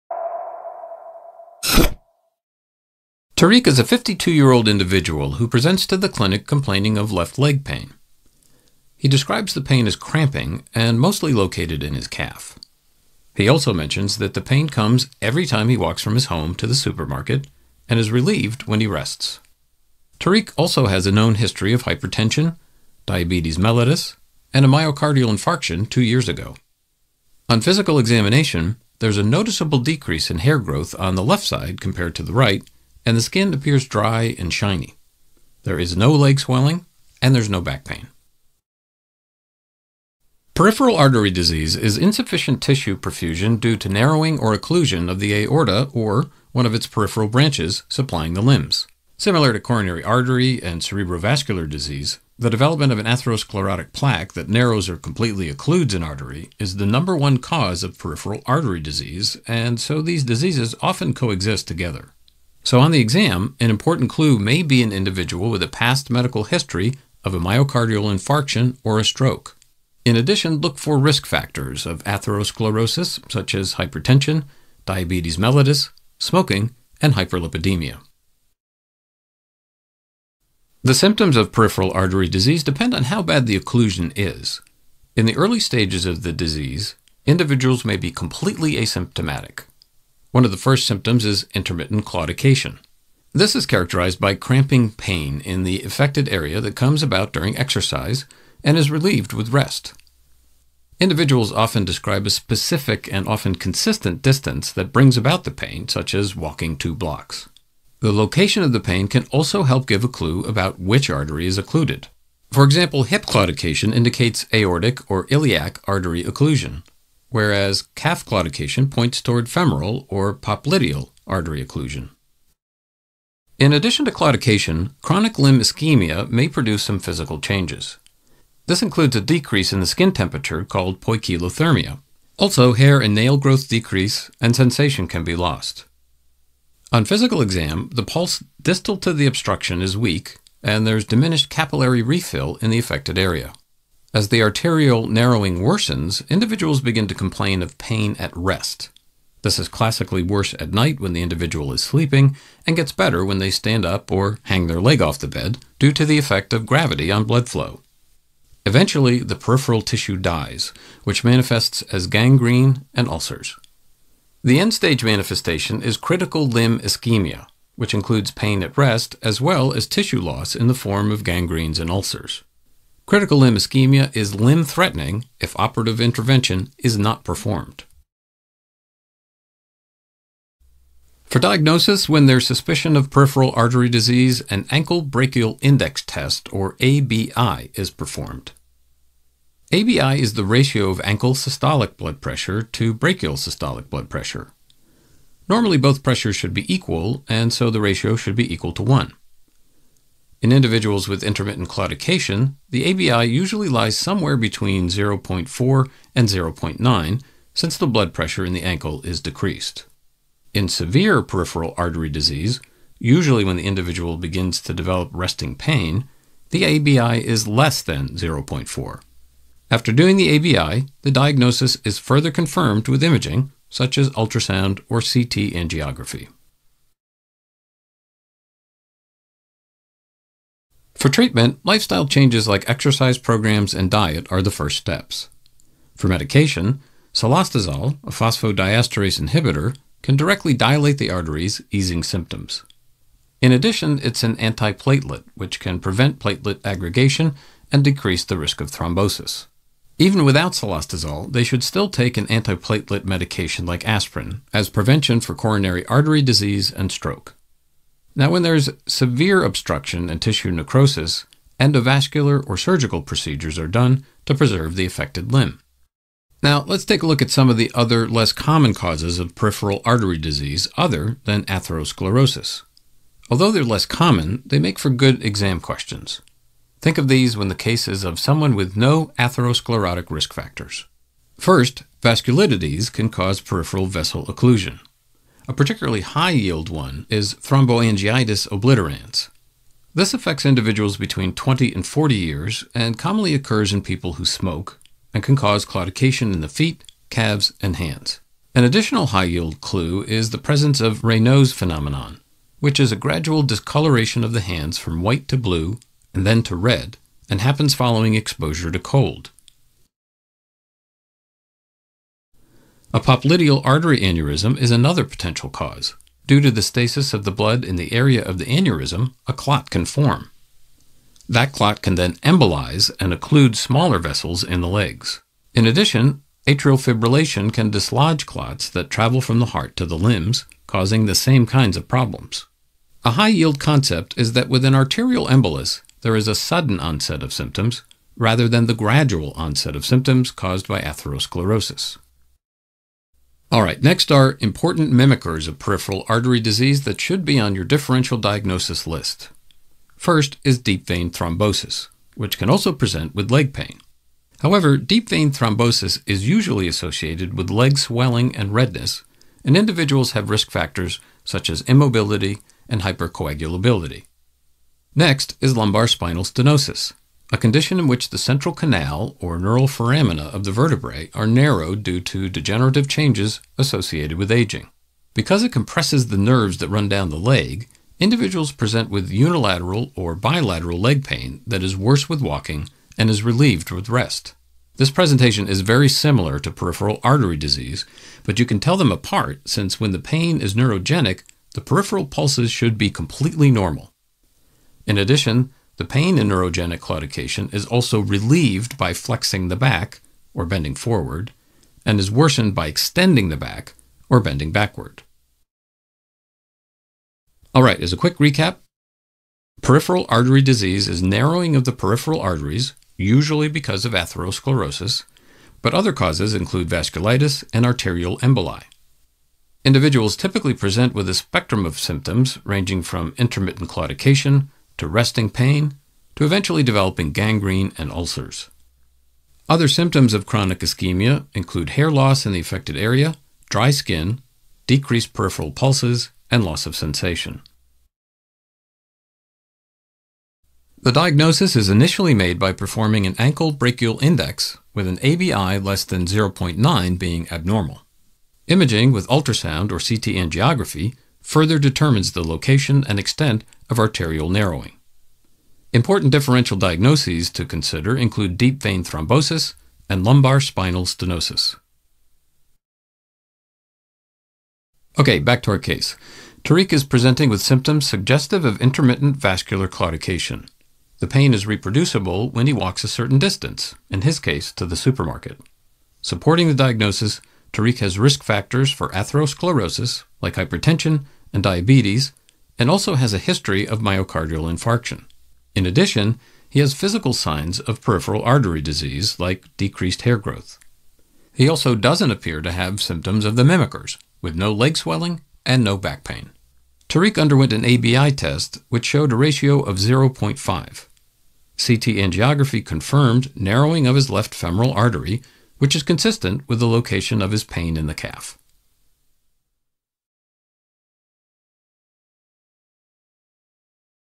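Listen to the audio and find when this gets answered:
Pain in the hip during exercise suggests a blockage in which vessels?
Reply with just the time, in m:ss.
1:54.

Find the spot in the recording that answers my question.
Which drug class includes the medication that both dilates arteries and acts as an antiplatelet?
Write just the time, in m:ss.
3:58.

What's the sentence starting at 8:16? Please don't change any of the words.
Tariq underwent an ABI test, which showed a ratio of 0.5.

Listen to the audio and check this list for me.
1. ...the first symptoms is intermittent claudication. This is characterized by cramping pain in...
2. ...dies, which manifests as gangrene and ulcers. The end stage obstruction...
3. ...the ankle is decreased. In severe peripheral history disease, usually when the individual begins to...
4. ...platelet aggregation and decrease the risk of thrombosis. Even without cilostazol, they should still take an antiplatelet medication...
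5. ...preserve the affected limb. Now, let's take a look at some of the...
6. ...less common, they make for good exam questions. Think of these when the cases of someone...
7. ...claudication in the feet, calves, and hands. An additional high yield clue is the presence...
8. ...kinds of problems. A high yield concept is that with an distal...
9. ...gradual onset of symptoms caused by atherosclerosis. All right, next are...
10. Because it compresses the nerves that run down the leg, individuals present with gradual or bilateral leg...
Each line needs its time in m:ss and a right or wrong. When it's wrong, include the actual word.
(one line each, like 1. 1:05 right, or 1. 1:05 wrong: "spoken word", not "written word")
1. 1:30 right
2. 2:40 wrong: "manifestation", not "obstruction"
3. 3:28 wrong: "artery", not "history"
4. 4:06 right
5. 4:24 right
6. 4:33 right
7. 4:55 right
8. 5:31 wrong: "arterial", not "distal"
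9. 5:38 right
10. 6:15 wrong: "unilateral", not "gradual".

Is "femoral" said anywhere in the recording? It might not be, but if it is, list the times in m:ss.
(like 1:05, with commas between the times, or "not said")
1:59, 8:24.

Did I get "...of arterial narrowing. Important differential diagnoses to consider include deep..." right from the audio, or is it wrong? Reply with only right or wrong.
right.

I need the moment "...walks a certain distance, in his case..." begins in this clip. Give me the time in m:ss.
7:52.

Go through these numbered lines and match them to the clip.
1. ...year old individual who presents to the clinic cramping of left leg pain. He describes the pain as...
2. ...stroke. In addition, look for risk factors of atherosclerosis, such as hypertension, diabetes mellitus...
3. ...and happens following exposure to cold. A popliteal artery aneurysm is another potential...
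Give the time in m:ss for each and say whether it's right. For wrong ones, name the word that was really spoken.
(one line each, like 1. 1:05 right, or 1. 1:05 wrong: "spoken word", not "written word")
1. 0:04 wrong: "complaining", not "cramping"
2. 1:09 right
3. 5:07 right.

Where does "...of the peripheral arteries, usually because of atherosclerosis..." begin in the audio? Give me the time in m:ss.
6:51.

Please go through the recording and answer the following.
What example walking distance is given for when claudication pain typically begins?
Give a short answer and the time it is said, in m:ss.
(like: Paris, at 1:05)
Two blocks, at 1:46.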